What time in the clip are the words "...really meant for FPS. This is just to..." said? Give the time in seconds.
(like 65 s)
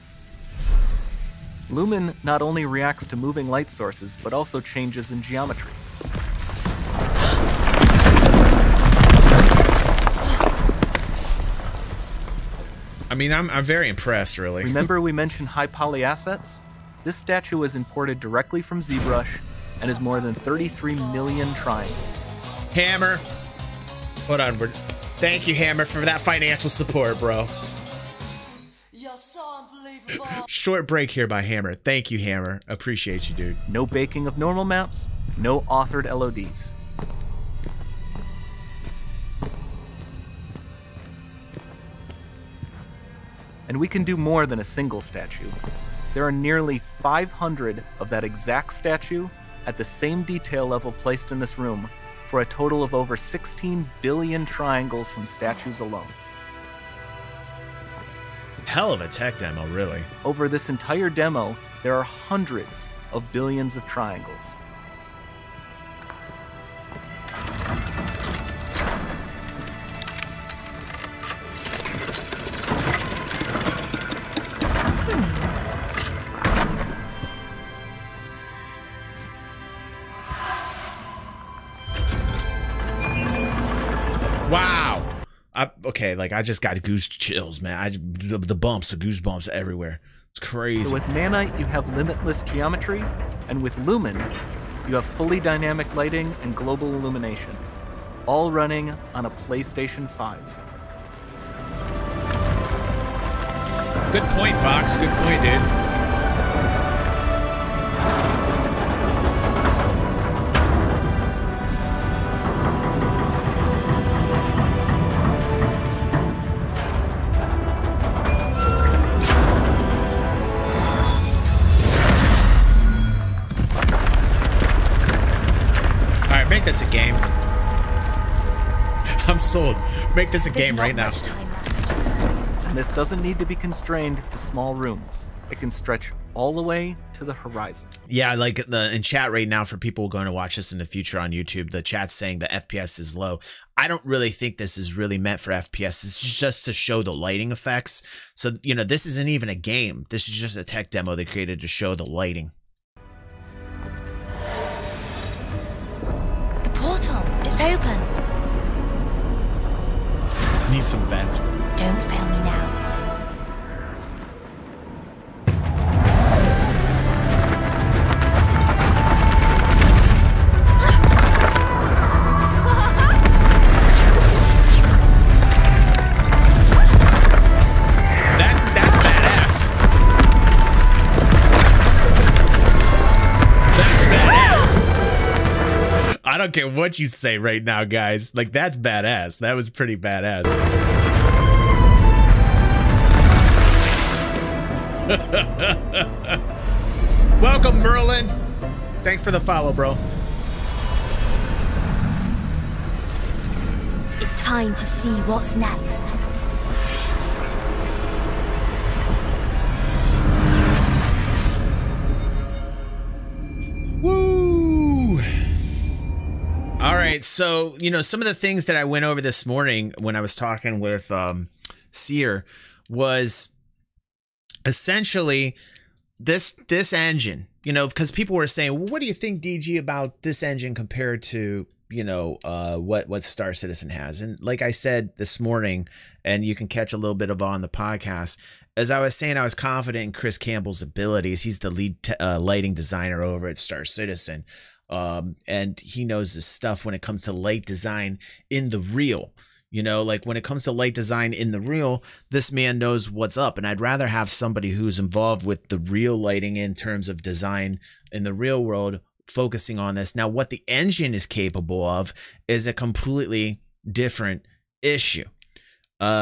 144 s.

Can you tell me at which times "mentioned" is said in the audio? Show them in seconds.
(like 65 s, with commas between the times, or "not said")
15 s.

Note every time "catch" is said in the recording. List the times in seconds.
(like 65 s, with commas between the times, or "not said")
236 s.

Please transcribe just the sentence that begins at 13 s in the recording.
I mean, I'm, I'm very impressed, really.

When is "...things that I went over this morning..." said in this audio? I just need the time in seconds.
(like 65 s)
218 s.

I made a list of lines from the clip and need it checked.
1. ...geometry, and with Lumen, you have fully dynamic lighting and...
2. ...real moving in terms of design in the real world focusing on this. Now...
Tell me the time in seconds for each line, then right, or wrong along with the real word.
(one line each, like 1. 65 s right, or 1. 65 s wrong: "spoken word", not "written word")
1. 92 s right
2. 255 s wrong: "lighting", not "moving".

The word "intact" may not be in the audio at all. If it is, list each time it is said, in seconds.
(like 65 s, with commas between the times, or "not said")
not said.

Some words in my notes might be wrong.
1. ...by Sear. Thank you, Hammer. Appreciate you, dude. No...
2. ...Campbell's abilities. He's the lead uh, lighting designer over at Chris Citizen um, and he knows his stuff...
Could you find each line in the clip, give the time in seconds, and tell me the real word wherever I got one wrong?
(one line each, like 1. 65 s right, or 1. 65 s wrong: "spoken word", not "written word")
1. 31 s wrong: "Hammer", not "Sear"
2. 240 s wrong: "Star", not "Chris".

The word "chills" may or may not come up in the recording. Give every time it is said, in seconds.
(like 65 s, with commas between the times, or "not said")
87 s.